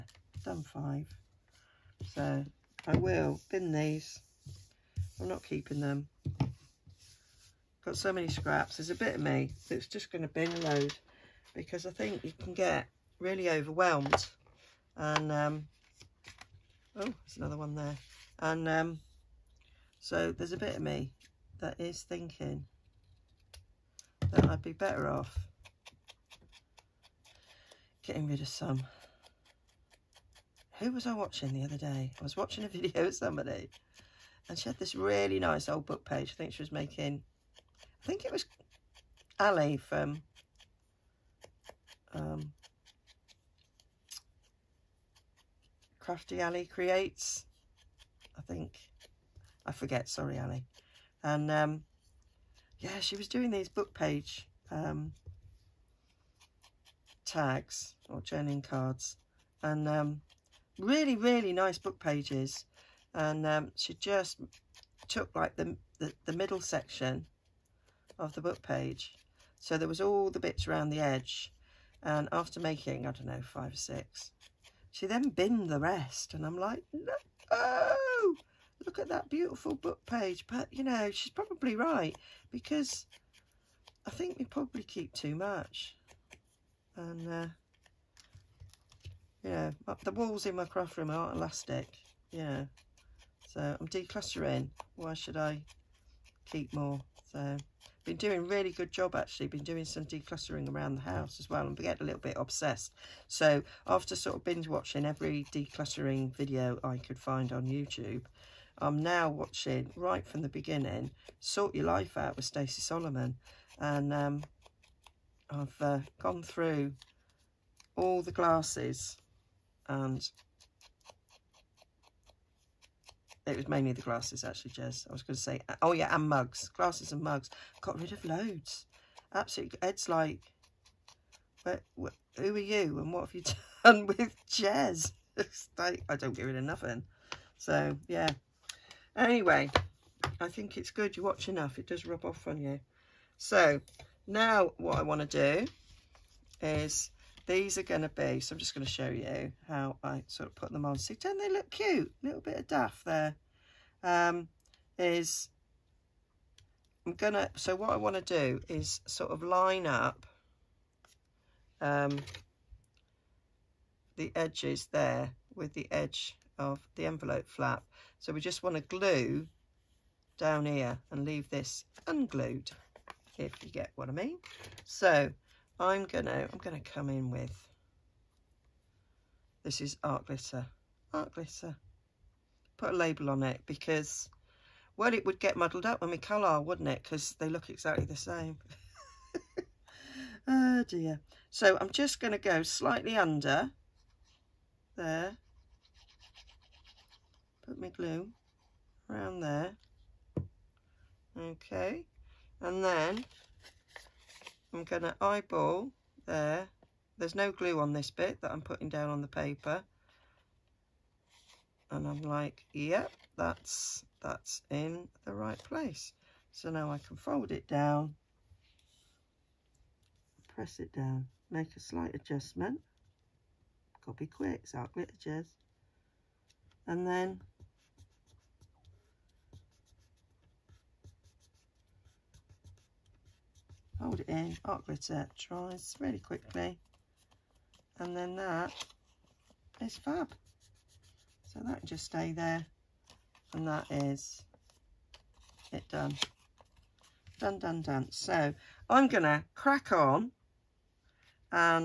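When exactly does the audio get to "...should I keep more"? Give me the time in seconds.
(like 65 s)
95 s.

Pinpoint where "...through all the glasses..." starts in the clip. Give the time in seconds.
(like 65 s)
116 s.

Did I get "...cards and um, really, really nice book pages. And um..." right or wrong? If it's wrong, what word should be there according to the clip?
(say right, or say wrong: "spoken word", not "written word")
right.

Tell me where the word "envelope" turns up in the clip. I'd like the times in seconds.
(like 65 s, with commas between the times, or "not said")
167 s.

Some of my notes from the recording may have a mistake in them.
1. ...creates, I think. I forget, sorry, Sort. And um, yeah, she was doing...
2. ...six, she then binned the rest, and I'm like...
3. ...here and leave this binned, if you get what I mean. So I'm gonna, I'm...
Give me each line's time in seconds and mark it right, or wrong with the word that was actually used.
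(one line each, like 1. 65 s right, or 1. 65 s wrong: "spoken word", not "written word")
1. 46 s wrong: "Annie", not "Sort"
2. 73 s right
3. 170 s wrong: "unglued", not "binned".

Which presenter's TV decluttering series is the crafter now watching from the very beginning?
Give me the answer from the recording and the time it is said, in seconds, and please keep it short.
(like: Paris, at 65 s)
Sort Your Life Out with Stacey Solomon, at 111 s.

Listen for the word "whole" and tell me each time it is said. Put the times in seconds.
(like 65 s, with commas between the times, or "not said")
not said.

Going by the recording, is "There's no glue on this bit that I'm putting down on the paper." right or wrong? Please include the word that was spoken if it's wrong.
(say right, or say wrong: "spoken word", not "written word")
right.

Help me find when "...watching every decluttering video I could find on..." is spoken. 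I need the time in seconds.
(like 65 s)
104 s.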